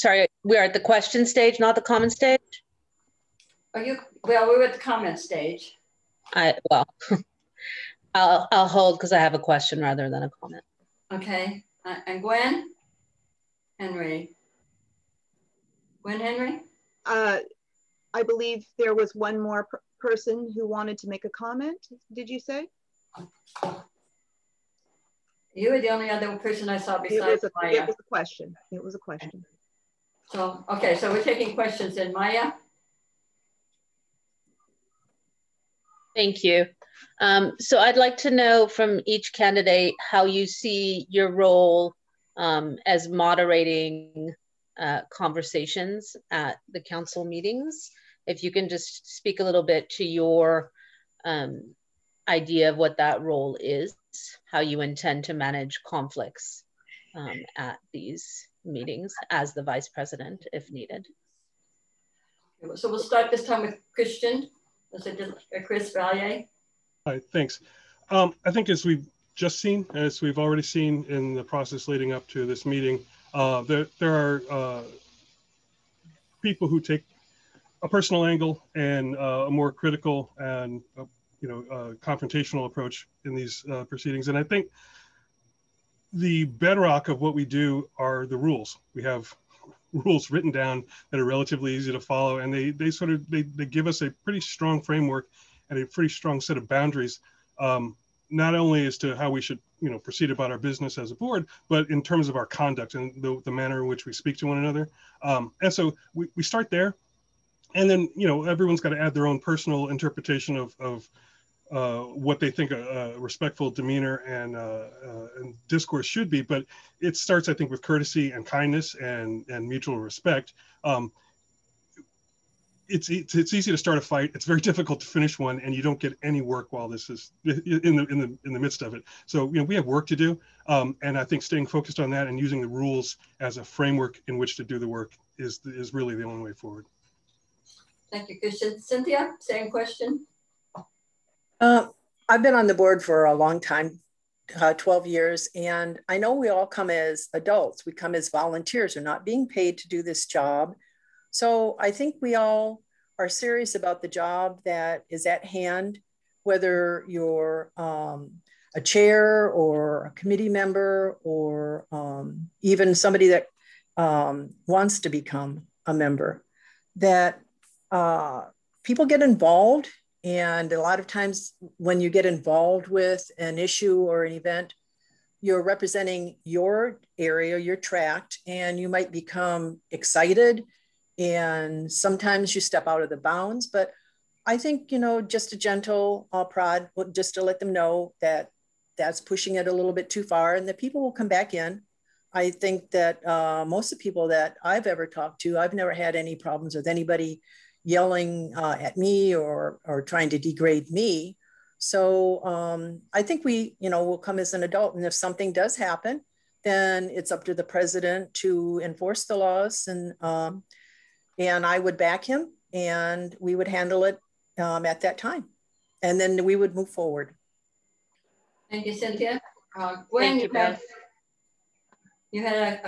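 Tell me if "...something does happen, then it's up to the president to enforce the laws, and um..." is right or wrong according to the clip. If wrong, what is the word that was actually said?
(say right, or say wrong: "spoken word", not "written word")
right.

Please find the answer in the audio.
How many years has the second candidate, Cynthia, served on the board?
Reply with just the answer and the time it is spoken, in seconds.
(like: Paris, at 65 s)
12 years, at 144 s.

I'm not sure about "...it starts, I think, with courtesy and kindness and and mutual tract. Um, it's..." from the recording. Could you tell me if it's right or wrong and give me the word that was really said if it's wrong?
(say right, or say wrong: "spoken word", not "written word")
wrong: "respect", not "tract".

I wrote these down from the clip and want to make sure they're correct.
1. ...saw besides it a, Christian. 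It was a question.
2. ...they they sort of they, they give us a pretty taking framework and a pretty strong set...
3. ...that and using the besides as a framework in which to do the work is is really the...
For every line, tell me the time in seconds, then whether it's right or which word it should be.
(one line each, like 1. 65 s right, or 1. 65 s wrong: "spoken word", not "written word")
1. 26 s wrong: "Maya", not "Christian"
2. 92 s wrong: "strong", not "taking"
3. 132 s wrong: "rules", not "besides".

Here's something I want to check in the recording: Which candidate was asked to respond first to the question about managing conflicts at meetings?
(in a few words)
Chris Valier.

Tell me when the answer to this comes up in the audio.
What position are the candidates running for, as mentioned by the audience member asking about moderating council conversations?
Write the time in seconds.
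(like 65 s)
59 s.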